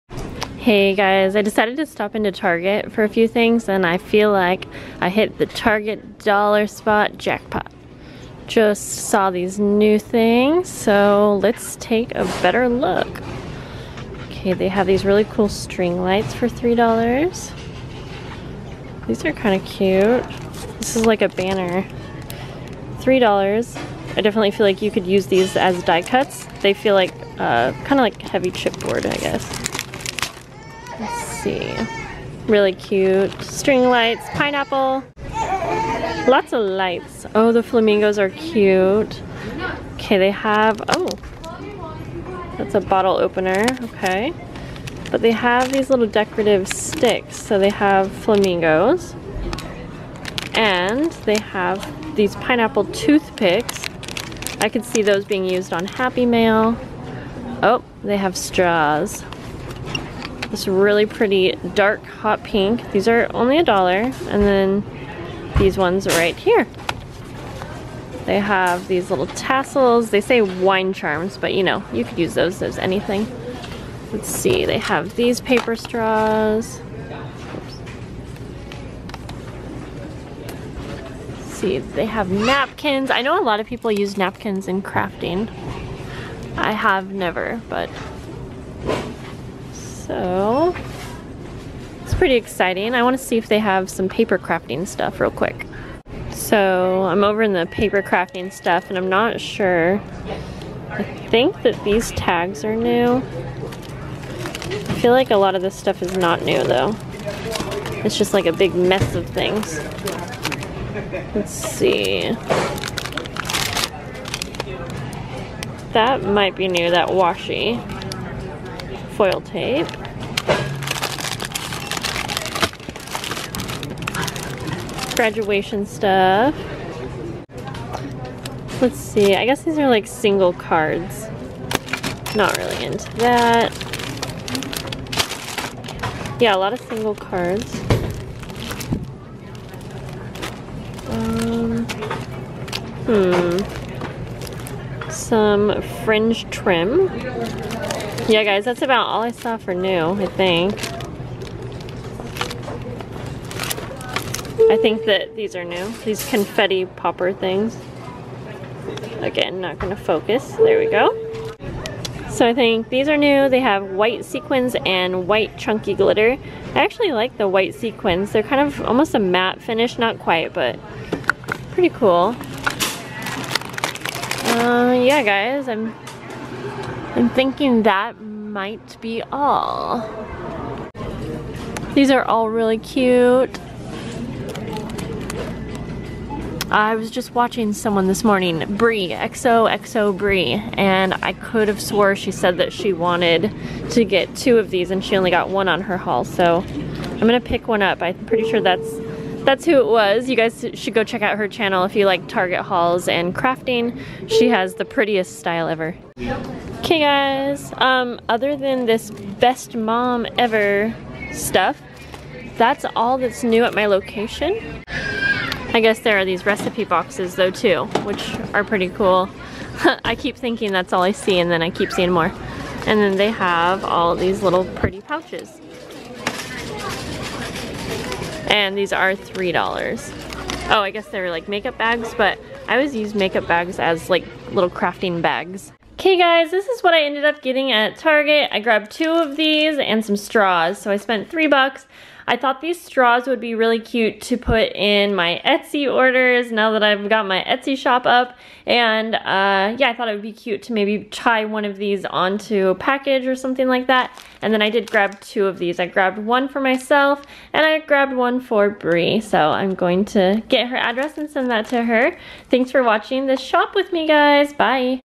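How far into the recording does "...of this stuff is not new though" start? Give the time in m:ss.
1:45.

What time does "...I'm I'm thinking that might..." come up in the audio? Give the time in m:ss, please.
2:55.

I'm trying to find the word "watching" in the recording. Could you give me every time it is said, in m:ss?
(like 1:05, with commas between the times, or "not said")
3:07, 4:22.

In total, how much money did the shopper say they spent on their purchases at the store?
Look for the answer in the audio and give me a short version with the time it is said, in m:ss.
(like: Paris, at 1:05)
three bucks, at 4:01.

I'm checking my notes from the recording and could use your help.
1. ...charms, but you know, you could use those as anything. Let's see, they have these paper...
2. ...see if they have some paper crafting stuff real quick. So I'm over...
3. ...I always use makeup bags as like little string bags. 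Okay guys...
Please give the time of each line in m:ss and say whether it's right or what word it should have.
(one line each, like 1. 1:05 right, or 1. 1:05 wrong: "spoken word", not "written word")
1. 1:10 right
2. 1:33 right
3. 3:52 wrong: "crafting", not "string".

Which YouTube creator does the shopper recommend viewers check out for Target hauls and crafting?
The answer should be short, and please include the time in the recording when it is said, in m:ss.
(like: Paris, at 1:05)
XOXO Brie, at 3:09.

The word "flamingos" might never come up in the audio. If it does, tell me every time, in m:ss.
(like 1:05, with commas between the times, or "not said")
0:37, 0:48.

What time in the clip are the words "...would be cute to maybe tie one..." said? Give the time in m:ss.
4:10.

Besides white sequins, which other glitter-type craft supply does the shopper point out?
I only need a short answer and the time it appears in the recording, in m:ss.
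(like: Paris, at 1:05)
white chunky glitter, at 2:45.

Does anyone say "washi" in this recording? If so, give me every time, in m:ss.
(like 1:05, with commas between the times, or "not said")
1:57.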